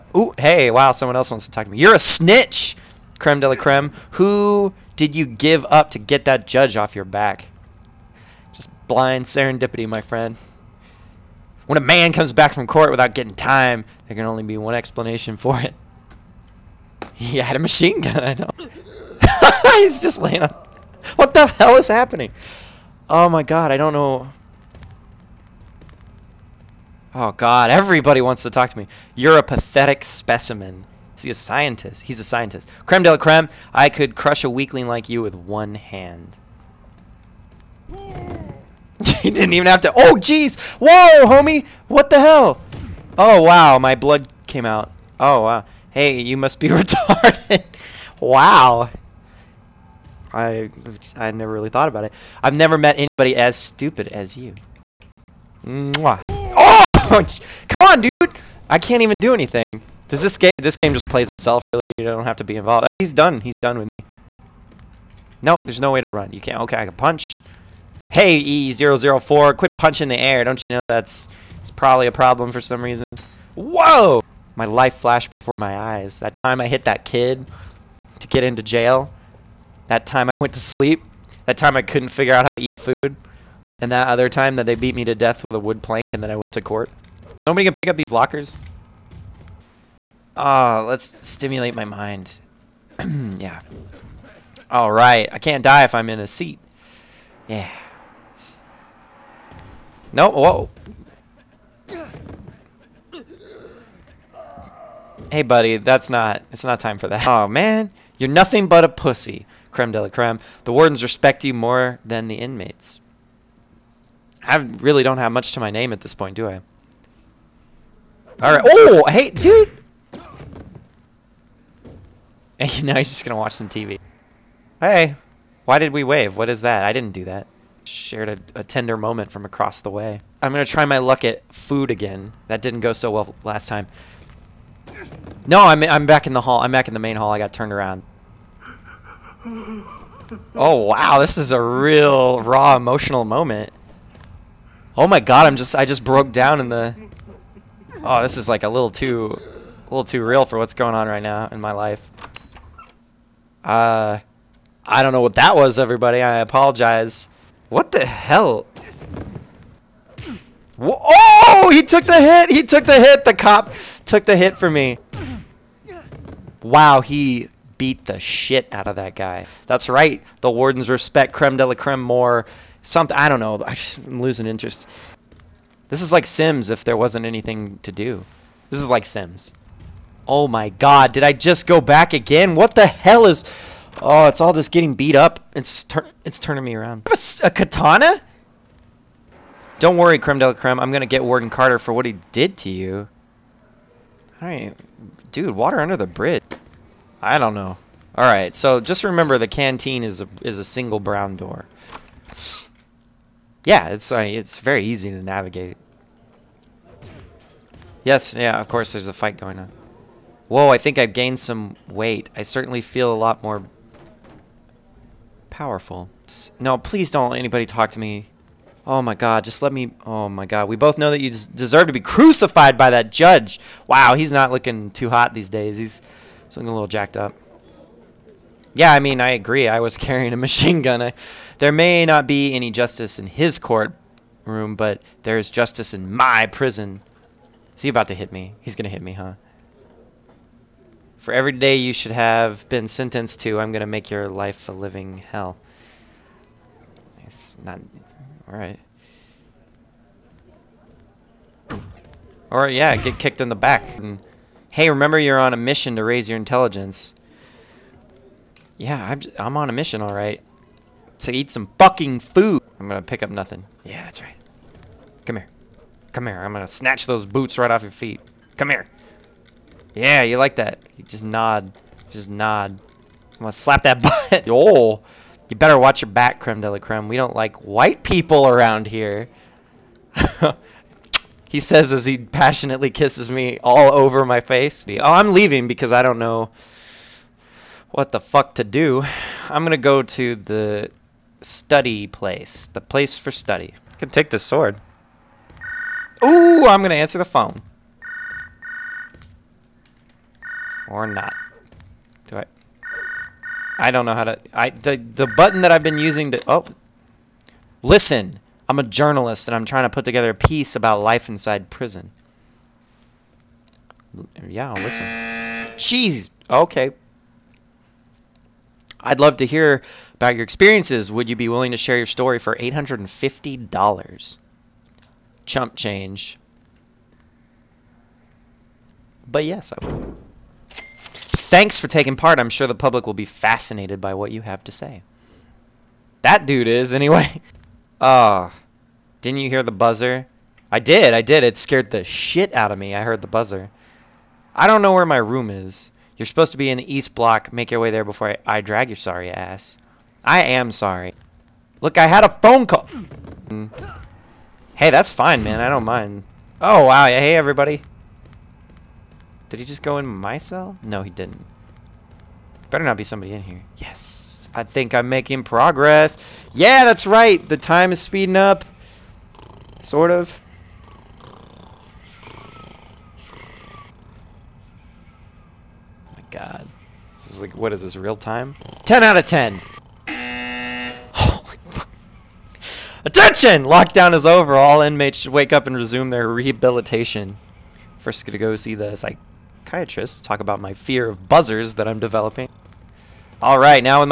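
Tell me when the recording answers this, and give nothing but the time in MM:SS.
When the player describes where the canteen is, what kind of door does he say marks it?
03:20.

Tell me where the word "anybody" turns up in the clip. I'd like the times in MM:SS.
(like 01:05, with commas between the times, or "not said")
00:52, 03:37.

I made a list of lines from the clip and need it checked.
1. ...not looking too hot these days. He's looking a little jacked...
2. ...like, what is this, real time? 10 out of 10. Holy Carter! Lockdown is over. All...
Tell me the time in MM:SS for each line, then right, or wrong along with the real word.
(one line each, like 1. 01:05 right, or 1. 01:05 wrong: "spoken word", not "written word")
1. 03:44 right
2. 06:17 wrong: "Attention", not "Carter".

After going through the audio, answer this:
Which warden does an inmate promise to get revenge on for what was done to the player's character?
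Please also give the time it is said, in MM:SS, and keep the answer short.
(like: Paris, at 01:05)
Warden Carter, at 03:11.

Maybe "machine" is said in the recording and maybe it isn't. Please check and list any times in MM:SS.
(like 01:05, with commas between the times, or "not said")
00:17, 03:50.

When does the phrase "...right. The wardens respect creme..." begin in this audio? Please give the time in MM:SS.
02:49.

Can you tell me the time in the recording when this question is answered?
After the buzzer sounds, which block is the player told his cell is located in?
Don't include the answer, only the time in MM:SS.
05:46.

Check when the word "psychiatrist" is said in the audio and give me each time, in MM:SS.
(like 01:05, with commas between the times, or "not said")
06:28.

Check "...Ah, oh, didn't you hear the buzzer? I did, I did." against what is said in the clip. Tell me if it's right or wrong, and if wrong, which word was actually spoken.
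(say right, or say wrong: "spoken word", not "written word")
right.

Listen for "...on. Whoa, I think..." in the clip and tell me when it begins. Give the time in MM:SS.
03:29.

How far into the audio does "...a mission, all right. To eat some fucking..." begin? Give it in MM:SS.
04:19.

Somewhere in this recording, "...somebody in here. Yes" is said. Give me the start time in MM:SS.
06:03.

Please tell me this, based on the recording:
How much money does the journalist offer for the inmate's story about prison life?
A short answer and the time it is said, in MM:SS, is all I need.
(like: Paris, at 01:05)
$850, at 05:22.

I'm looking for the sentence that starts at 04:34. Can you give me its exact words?
oh, you better watch your back, creme de la creme.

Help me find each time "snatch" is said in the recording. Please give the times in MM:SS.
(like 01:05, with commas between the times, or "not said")
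04:26.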